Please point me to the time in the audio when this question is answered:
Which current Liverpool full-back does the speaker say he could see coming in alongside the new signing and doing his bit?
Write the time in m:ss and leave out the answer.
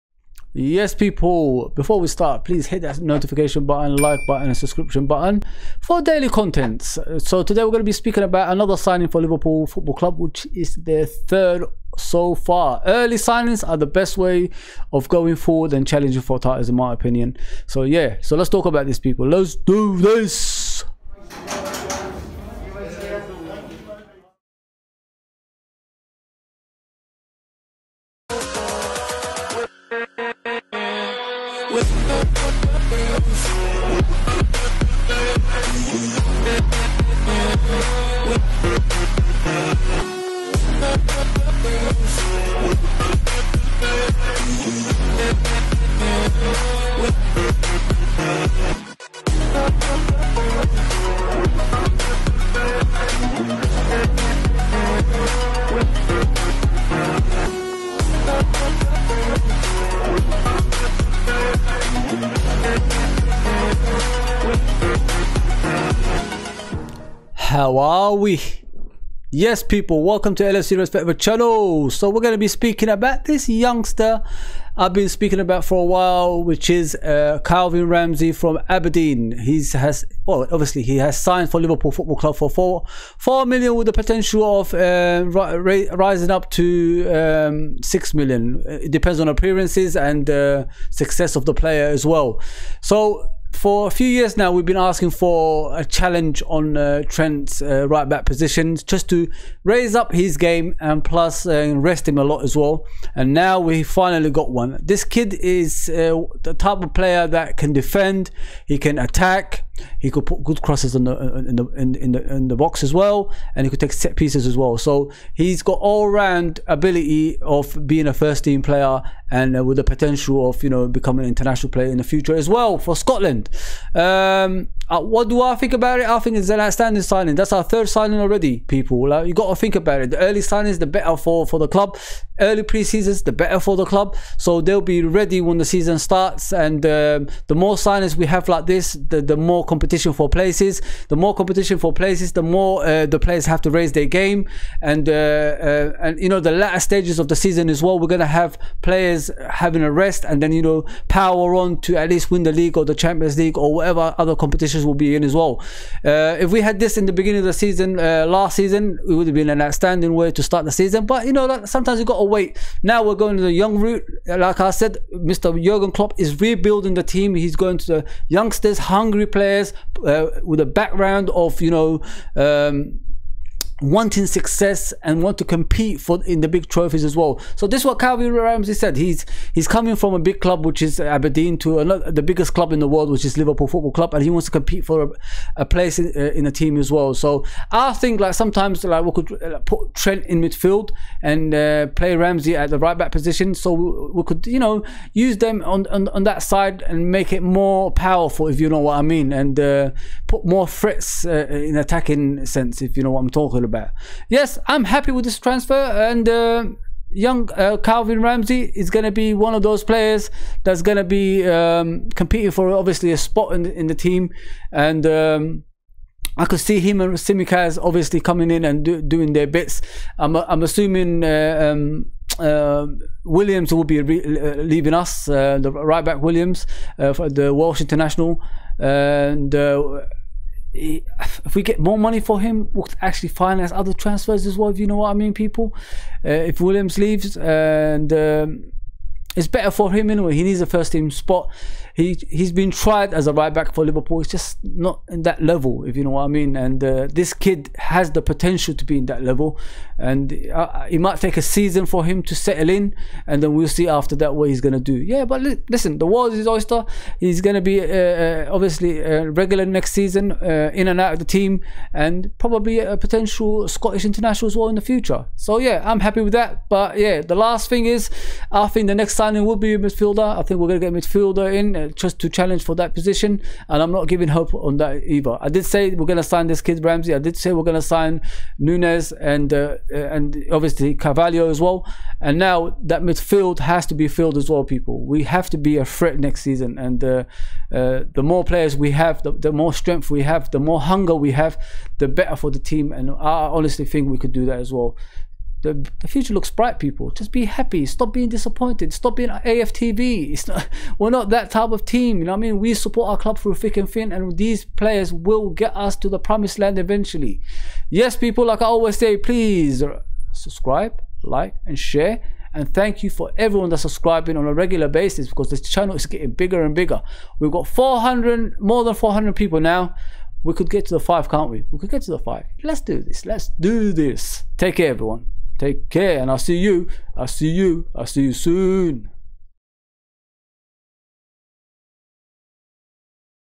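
3:37.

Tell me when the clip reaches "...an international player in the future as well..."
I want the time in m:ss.
2:01.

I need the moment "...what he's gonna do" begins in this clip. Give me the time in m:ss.
4:14.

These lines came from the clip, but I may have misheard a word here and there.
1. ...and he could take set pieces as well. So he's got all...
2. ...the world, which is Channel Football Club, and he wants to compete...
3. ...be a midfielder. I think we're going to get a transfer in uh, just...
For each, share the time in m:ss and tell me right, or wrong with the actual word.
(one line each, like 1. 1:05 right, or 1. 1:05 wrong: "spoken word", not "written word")
1. 1:53 right
2. 3:02 wrong: "Liverpool", not "Channel"
3. 4:29 wrong: "midfielder", not "transfer".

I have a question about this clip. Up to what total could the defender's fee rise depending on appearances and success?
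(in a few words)
6 million.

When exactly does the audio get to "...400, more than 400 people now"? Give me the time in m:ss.
5:17.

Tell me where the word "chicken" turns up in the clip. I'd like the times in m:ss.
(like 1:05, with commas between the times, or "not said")
not said.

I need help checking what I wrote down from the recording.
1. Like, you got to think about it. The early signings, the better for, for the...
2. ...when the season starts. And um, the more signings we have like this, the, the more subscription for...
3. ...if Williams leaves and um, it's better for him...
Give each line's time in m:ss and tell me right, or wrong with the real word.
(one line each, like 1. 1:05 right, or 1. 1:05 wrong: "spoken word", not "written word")
1. 2:09 right
2. 2:15 wrong: "competition", not "subscription"
3. 3:56 right.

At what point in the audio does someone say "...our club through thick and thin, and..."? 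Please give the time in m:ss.
5:03.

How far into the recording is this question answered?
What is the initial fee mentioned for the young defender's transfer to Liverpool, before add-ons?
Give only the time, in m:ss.
1:23.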